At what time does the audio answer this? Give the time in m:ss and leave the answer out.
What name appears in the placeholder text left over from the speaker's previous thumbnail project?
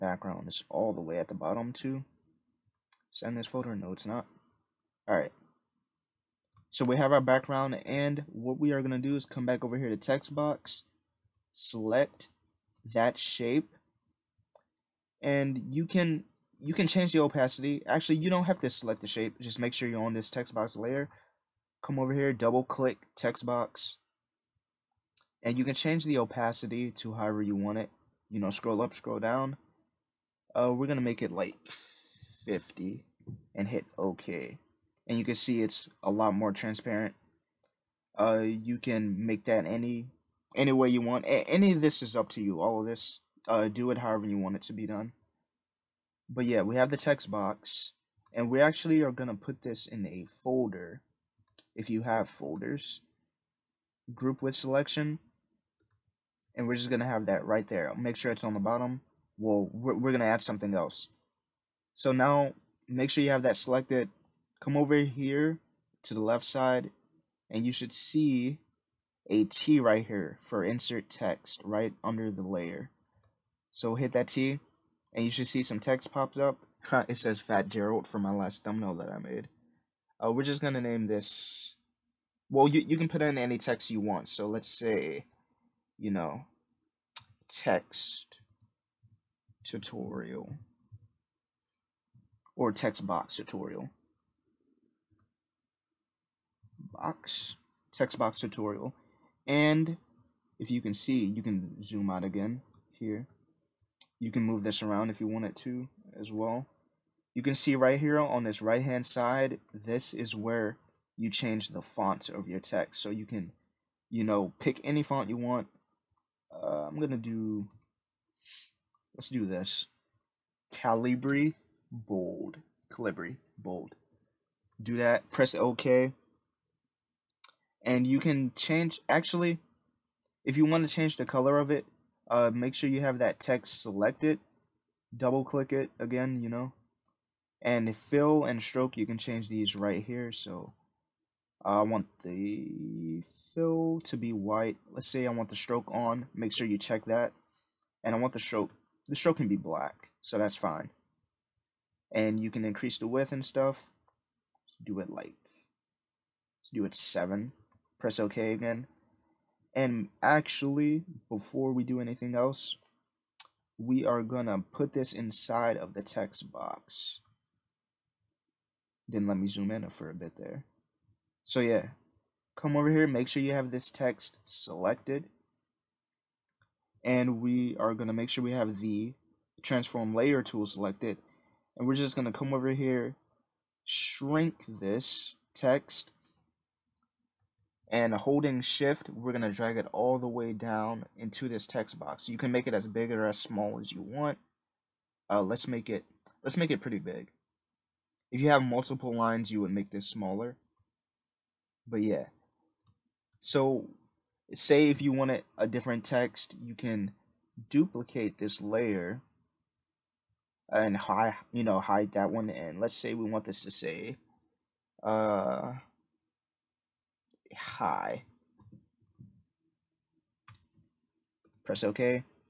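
1:17.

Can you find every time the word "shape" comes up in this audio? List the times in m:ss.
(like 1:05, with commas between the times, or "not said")
0:13, 0:19.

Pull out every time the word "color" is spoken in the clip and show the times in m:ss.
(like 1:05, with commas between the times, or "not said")
2:11.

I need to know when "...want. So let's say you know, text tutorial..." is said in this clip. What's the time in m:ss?
1:23.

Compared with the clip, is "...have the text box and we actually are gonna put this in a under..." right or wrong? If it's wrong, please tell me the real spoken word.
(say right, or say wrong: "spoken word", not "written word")
wrong: "folder", not "under".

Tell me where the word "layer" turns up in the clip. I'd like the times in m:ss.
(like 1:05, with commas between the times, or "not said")
0:20, 1:12, 3:00, 3:28.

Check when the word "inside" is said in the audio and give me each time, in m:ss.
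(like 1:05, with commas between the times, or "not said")
2:45.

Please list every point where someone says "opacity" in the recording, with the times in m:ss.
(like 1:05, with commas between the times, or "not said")
0:17, 0:26.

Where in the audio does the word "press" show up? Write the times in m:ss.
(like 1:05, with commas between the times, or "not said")
2:05, 2:37, 3:41.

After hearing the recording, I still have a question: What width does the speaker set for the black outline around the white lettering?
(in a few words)
7.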